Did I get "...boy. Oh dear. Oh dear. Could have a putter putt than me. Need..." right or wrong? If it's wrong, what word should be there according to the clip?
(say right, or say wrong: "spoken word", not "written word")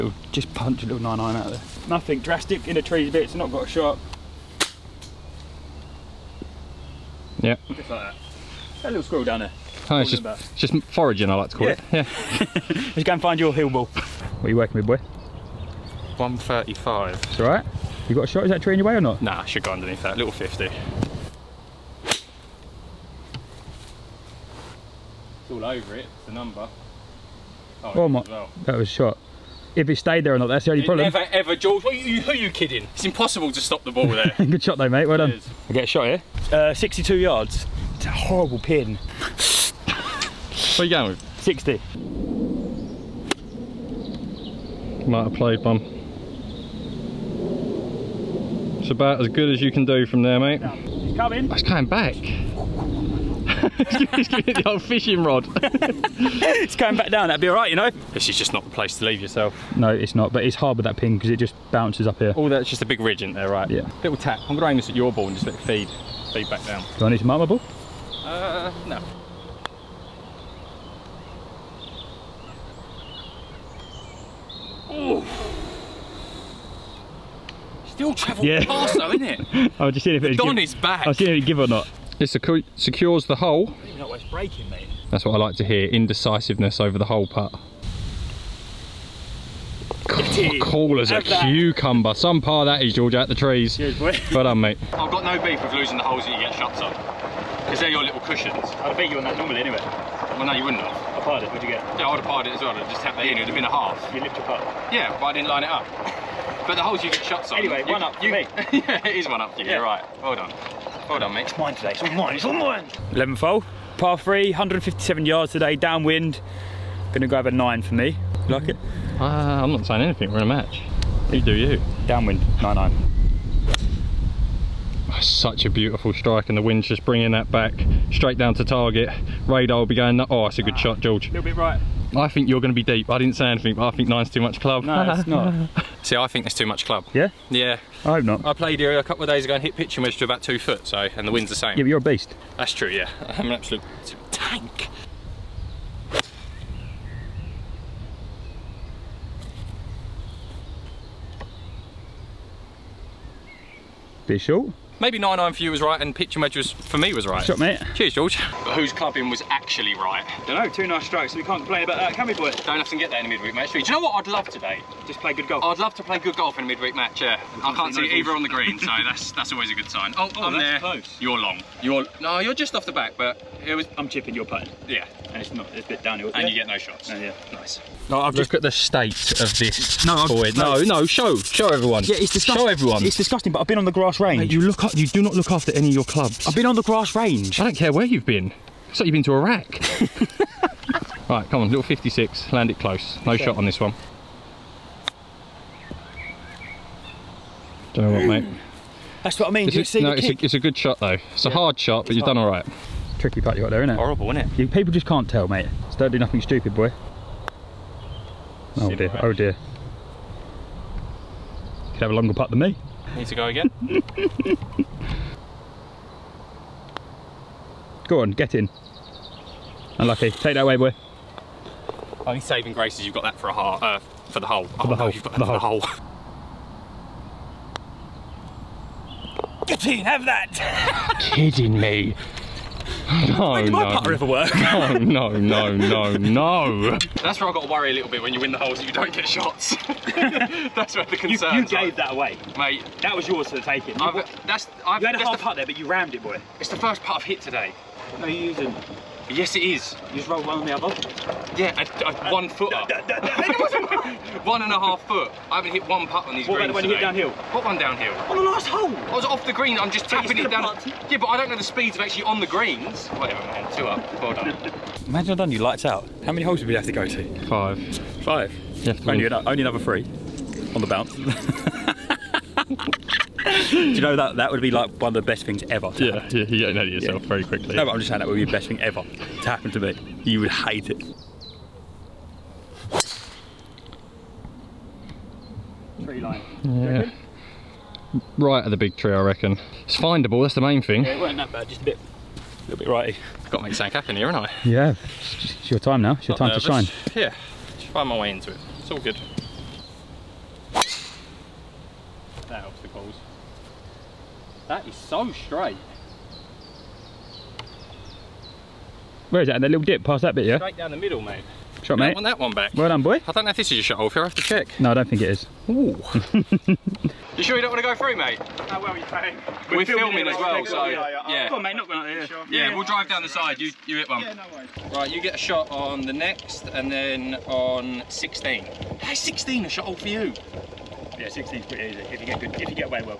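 wrong: "longer", not "putter".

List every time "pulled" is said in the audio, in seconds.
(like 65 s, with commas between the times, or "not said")
not said.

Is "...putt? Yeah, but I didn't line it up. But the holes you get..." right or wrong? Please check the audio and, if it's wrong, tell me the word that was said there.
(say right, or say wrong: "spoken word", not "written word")
right.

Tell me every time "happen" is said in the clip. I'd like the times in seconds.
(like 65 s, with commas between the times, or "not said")
279 s, 293 s.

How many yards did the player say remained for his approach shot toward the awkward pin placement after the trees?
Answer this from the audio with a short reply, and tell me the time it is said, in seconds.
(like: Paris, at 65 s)
62, at 36 s.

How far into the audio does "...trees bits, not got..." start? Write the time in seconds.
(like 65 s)
2 s.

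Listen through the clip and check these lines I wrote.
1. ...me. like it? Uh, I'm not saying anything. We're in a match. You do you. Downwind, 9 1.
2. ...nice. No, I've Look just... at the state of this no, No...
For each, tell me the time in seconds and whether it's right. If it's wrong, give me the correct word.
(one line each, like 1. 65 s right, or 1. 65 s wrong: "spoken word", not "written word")
1. 117 s wrong: "9", not "1"
2. 177 s right.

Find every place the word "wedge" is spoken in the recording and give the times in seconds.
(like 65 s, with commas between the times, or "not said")
140 s, 156 s.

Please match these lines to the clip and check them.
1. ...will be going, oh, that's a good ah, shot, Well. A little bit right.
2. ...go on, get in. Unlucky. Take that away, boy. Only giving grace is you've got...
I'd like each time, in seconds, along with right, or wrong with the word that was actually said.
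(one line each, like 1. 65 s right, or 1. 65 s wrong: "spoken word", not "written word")
1. 129 s wrong: "George", not "Well"
2. 218 s wrong: "saving", not "giving".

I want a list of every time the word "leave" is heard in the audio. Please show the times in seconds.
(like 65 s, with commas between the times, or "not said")
59 s.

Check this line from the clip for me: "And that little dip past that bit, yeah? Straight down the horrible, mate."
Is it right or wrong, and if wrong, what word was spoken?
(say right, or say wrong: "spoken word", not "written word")
wrong: "middle", not "horrible".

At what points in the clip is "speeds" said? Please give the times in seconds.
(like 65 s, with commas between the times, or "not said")
261 s.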